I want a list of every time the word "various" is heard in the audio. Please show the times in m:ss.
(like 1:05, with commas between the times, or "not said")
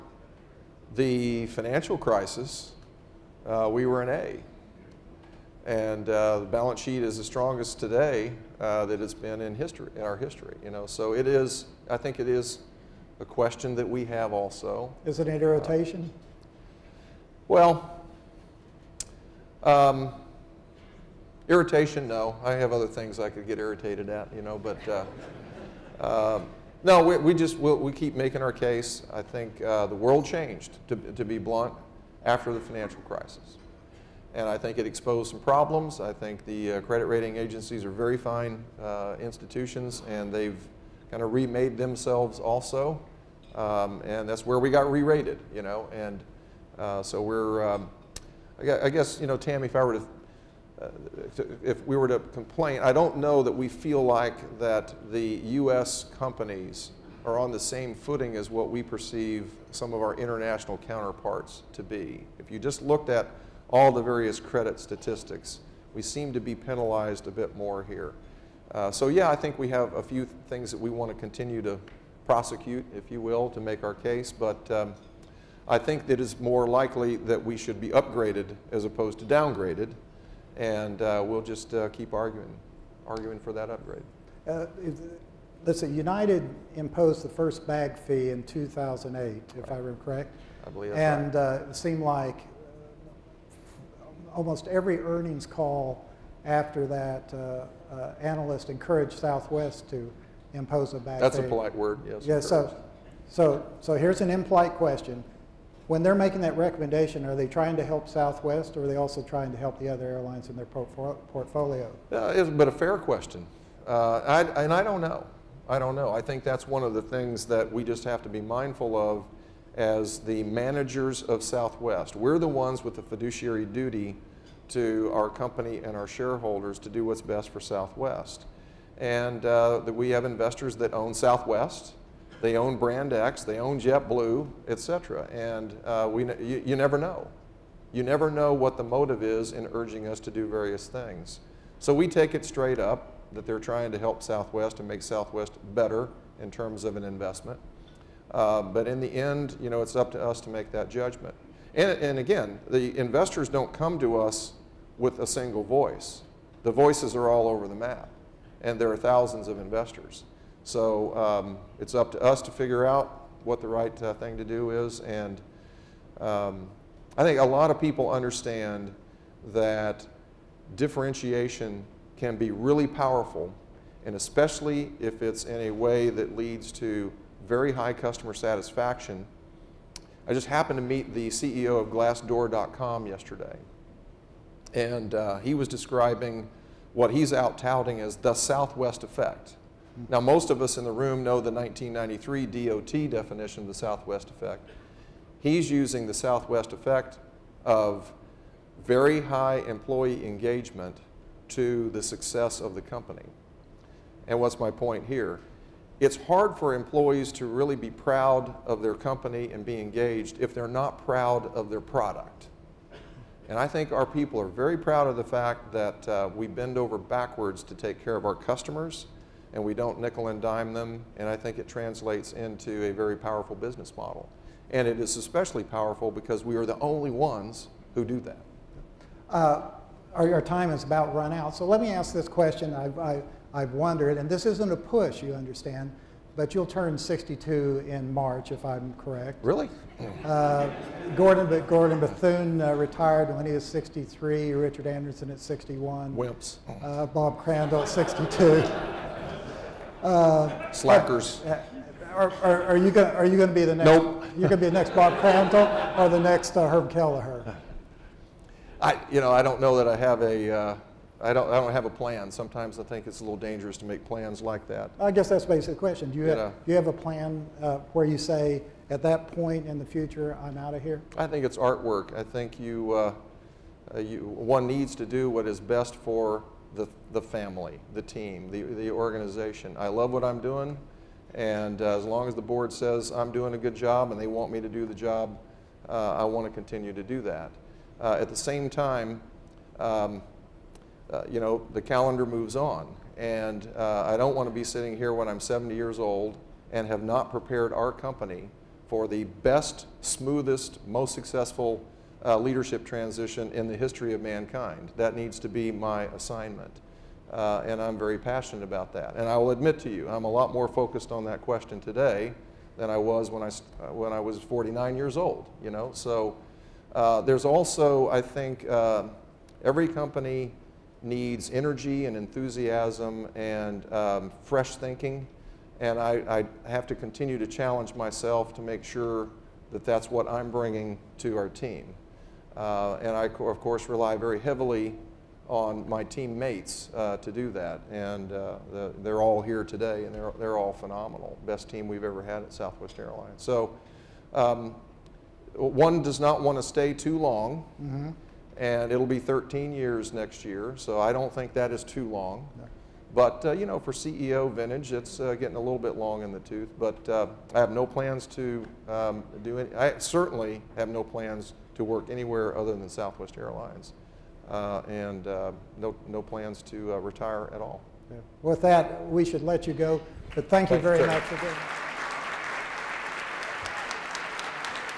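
1:04, 2:20.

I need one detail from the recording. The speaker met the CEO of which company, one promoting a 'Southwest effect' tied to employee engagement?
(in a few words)
Glassdoor.com.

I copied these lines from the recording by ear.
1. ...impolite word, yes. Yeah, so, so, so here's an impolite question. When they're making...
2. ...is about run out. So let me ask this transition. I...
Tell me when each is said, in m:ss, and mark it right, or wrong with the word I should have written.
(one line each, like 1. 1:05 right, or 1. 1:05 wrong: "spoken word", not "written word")
1. 1:41 wrong: "polite", not "impolite"
2. 3:50 wrong: "question", not "transition".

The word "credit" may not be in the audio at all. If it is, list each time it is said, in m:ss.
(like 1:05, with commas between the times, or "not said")
0:36, 1:04.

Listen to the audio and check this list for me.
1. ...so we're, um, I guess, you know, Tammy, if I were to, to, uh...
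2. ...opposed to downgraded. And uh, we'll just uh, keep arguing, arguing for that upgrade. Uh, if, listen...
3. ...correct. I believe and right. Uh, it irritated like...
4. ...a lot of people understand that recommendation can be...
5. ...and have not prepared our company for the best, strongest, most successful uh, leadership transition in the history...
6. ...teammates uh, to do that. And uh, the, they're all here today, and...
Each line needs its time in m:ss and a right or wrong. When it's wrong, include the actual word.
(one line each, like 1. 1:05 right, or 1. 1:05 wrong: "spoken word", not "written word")
1. 0:47 right
2. 1:18 right
3. 1:30 wrong: "seemed", not "irritated"
4. 2:47 wrong: "differentiation", not "recommendation"
5. 4:56 wrong: "smoothest", not "strongest"
6. 5:36 right.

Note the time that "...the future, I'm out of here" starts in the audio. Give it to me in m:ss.
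4:29.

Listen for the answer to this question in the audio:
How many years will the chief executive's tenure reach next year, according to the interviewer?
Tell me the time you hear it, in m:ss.
5:49.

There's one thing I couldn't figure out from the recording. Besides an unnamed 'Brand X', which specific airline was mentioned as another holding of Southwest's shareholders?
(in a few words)
JetBlue.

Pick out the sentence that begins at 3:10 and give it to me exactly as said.
Now, most of us in the room know the 1993 DOT definition of the Southwest effect.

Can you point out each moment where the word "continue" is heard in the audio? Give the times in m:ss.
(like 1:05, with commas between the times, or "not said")
1:11, 4:46, 5:26.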